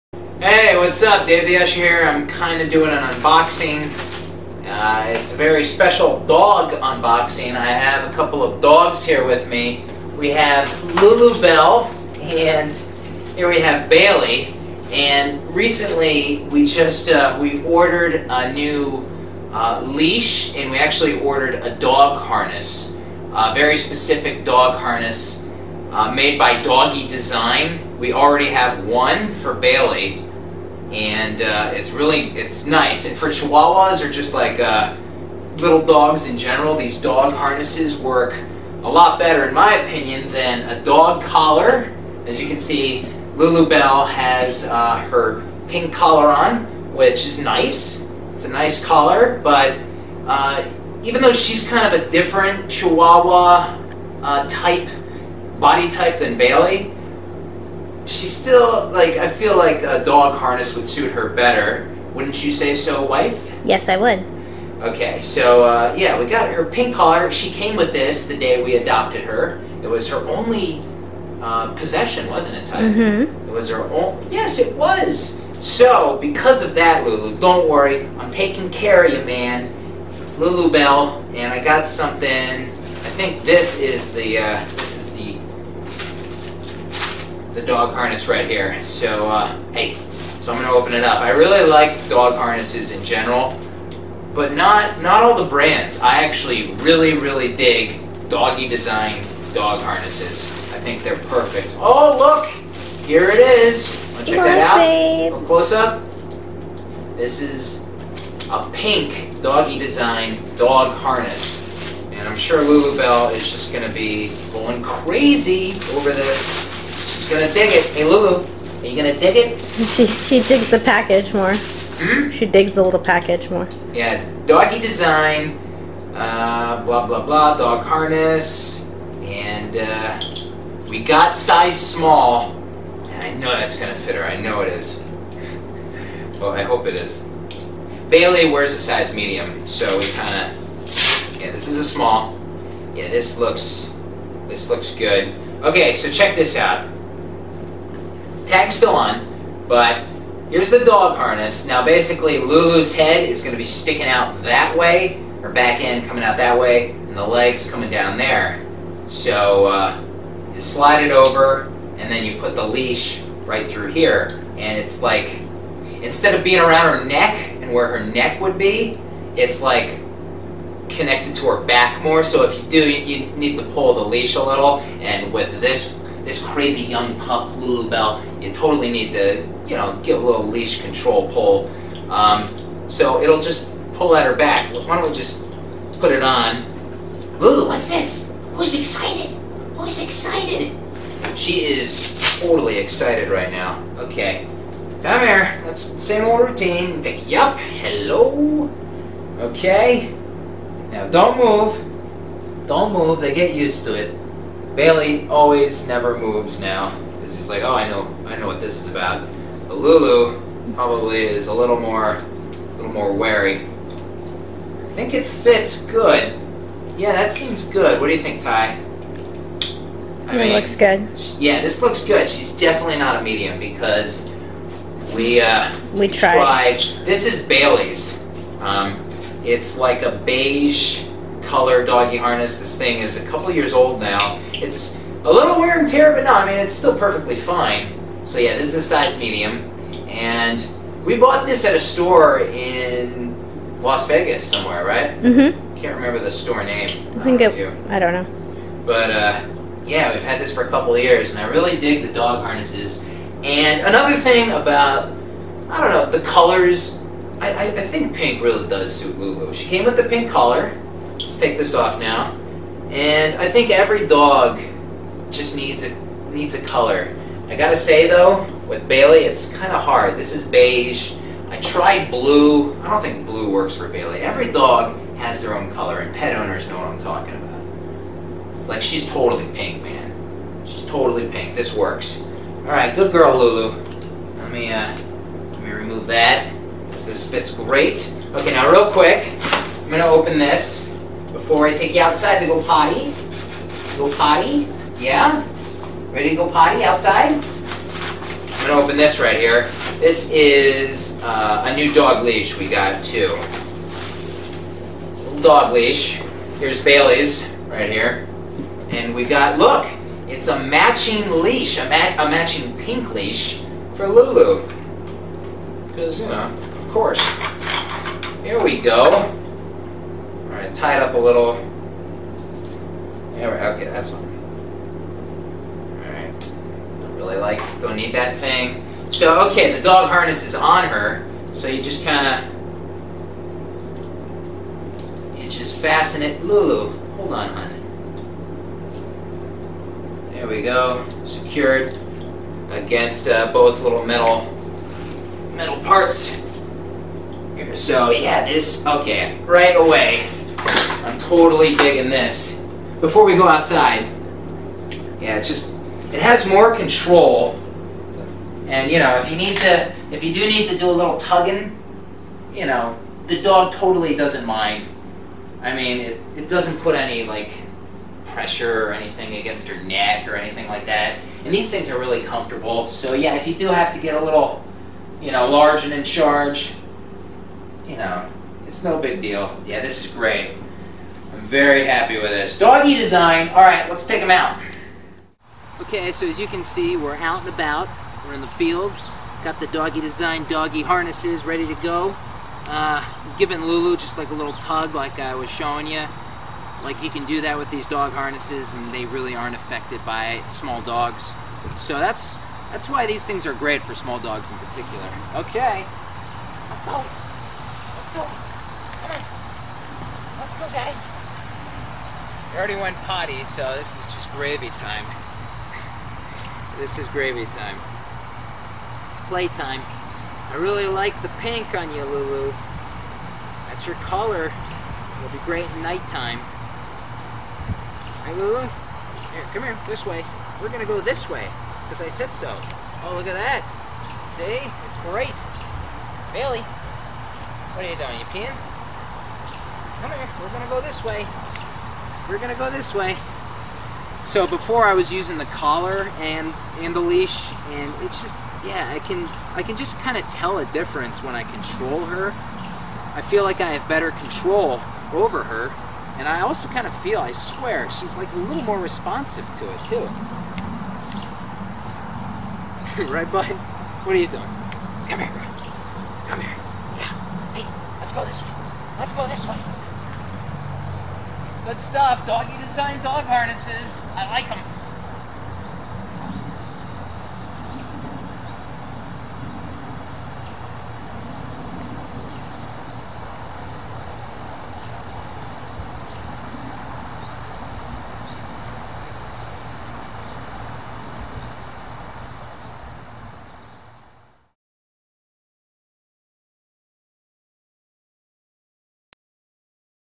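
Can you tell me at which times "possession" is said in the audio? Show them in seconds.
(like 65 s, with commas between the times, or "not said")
71 s.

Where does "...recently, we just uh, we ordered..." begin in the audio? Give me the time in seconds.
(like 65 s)
15 s.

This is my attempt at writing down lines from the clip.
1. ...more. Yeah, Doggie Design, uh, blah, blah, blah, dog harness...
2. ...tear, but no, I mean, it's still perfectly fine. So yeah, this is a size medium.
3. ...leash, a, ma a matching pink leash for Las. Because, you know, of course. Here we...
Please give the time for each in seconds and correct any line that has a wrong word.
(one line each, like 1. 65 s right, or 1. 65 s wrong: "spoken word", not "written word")
1. 123 s right
2. 235 s right
3. 311 s wrong: "Lulu", not "Las".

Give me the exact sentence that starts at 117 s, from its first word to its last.
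Hey, Lulu, are you gonna dig it?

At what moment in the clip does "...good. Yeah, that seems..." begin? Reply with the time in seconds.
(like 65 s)
215 s.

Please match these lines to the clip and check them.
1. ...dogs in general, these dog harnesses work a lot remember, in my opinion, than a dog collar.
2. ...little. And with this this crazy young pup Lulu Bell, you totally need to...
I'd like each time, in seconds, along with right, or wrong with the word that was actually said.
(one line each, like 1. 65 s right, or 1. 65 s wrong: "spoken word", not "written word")
1. 35 s wrong: "better", not "remember"
2. 174 s right.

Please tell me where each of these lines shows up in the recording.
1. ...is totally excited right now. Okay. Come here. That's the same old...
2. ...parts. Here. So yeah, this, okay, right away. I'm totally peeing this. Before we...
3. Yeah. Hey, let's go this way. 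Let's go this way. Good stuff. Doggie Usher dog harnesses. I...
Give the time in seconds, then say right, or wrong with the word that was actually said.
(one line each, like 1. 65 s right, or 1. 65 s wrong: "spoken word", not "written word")
1. 191 s right
2. 345 s wrong: "digging", not "peeing"
3. 467 s wrong: "Design", not "Usher".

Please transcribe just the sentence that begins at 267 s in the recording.
I gotta say though, with Bailey, it's kind of hard.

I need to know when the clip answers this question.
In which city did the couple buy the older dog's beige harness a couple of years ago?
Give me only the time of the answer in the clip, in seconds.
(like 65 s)
243 s.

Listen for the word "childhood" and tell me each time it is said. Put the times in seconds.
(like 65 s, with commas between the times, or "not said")
not said.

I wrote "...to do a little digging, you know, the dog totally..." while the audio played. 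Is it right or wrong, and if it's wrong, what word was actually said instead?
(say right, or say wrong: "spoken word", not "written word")
wrong: "tugging", not "digging".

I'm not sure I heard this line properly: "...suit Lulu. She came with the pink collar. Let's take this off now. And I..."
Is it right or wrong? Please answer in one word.
right.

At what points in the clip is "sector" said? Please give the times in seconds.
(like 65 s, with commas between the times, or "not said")
not said.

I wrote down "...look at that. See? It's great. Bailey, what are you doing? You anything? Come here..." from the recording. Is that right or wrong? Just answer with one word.
wrong.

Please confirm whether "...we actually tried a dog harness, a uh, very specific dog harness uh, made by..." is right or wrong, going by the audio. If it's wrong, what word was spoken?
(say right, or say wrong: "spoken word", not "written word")
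wrong: "ordered", not "tried".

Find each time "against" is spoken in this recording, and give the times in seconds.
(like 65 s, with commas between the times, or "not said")
342 s, 369 s.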